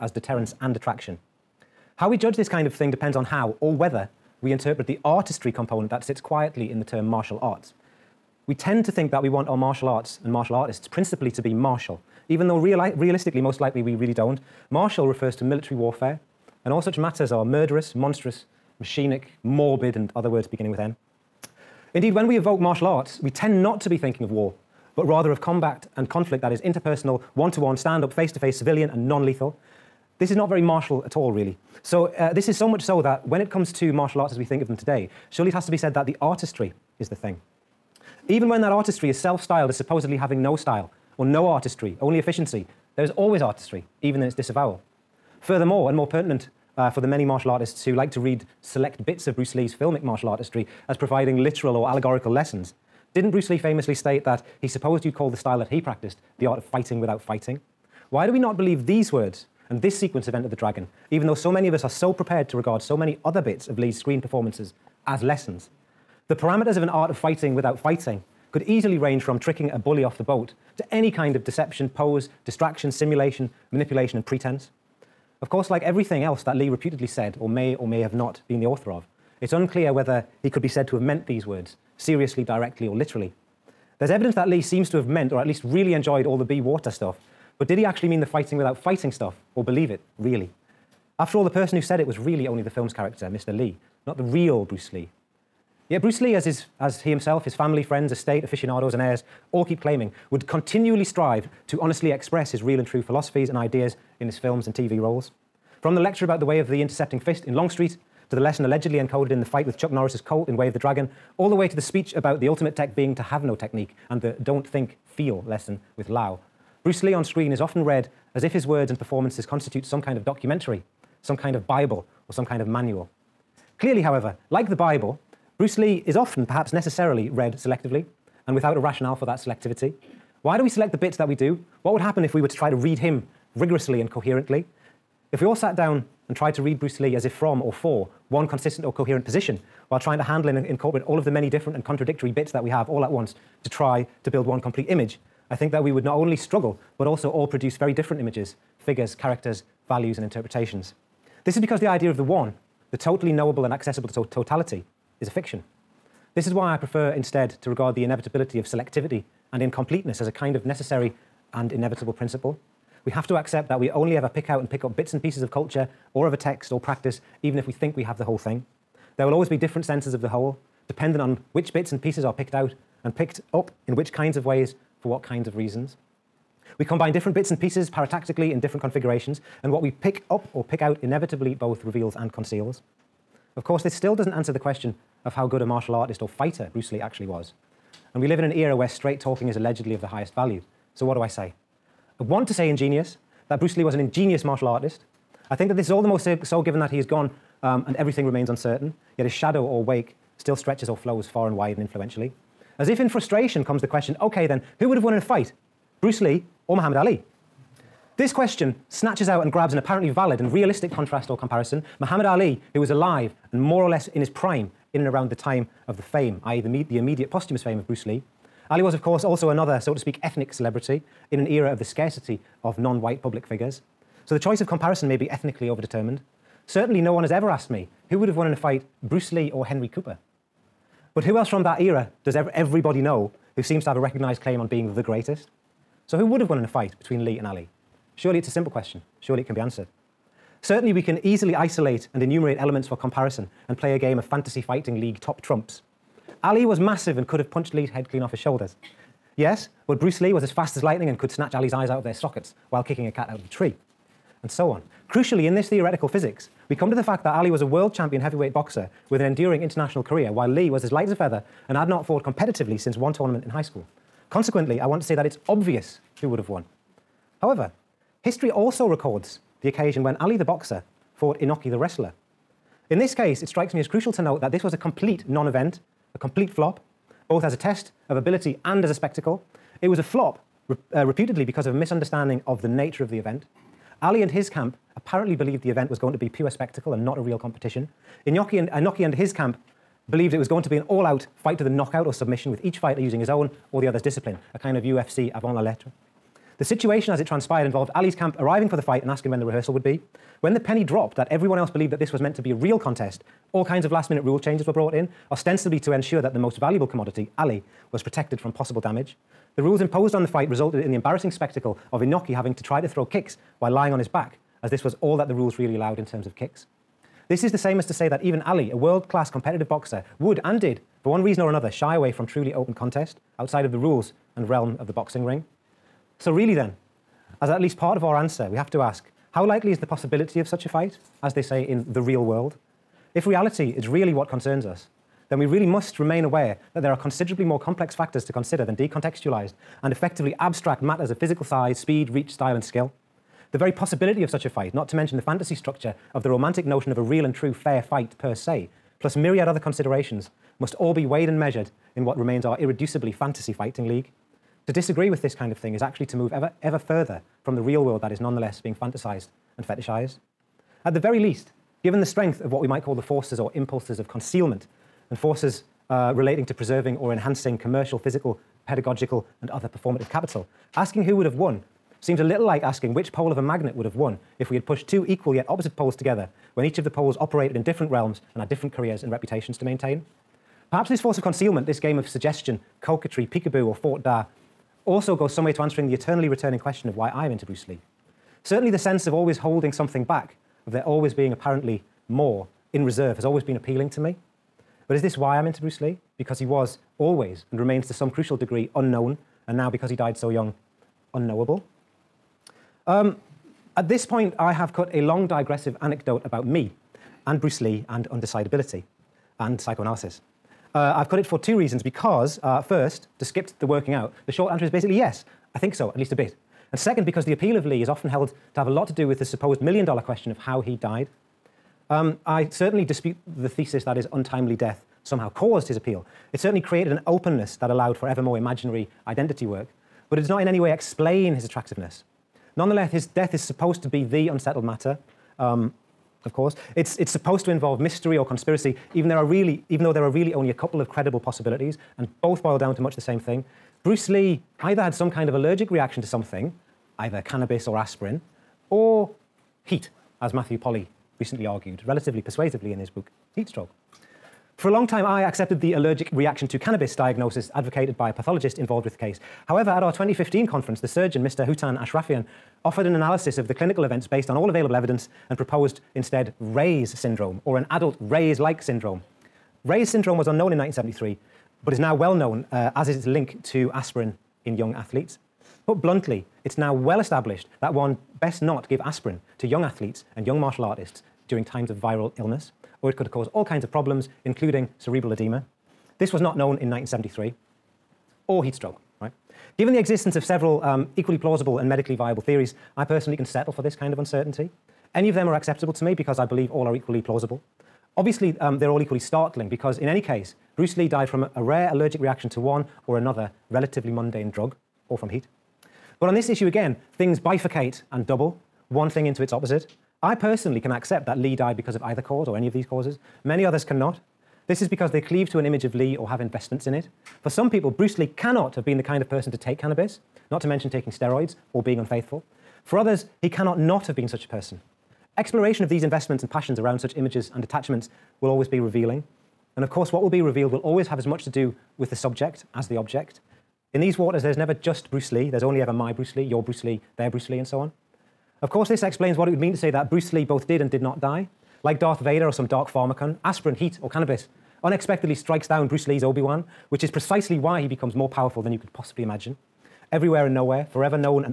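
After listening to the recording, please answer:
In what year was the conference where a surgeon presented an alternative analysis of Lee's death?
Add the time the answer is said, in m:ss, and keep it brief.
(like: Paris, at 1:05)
2015, at 7:39.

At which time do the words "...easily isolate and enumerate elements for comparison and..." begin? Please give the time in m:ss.
4:01.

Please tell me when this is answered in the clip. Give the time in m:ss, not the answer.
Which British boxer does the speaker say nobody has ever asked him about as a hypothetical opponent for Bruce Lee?
3:49.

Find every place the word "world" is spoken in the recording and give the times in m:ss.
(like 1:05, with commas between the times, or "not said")
4:17, 5:18, 5:32, 5:57.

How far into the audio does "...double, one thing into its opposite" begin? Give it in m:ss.
8:28.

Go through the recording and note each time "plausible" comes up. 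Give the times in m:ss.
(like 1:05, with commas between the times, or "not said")
8:11, 8:17.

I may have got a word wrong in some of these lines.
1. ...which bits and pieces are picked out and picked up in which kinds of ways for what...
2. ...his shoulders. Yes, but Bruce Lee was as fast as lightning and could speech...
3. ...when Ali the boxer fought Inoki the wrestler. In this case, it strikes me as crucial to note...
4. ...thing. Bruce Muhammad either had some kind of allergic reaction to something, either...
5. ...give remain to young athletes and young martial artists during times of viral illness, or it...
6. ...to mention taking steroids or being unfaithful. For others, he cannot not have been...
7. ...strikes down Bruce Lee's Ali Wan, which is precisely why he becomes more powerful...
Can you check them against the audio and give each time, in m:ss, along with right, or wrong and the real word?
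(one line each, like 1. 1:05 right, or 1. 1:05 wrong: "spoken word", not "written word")
1. 2:51 right
2. 4:08 wrong: "snatch", not "speech"
3. 4:30 right
4. 7:23 wrong: "Lee", not "Muhammad"
5. 7:58 wrong: "aspirin", not "remain"
6. 8:40 right
7. 9:05 wrong: "Obi", not "Ali".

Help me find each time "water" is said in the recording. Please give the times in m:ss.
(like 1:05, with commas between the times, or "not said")
1:26, 8:53.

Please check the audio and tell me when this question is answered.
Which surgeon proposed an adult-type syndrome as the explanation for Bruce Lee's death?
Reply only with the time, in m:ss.
7:41.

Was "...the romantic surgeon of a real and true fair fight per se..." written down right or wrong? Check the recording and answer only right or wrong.
wrong.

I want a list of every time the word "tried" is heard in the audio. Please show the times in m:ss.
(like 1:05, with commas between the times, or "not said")
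2:16.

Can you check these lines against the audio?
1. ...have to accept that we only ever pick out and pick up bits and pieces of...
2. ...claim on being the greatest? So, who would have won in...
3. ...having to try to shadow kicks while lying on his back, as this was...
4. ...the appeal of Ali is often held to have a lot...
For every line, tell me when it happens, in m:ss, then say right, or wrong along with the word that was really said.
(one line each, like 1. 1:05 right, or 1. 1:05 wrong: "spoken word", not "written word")
1. 2:43 right
2. 3:54 right
3. 5:12 wrong: "throw", not "shadow"
4. 6:57 wrong: "Lee", not "Ali".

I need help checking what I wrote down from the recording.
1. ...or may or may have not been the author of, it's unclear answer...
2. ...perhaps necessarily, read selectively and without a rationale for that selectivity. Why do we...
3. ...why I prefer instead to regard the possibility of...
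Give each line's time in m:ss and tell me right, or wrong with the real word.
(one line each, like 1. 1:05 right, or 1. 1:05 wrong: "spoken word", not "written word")
1. 1:17 wrong: "whether", not "answer"
2. 2:06 right
3. 2:36 wrong: "inevitability", not "possibility".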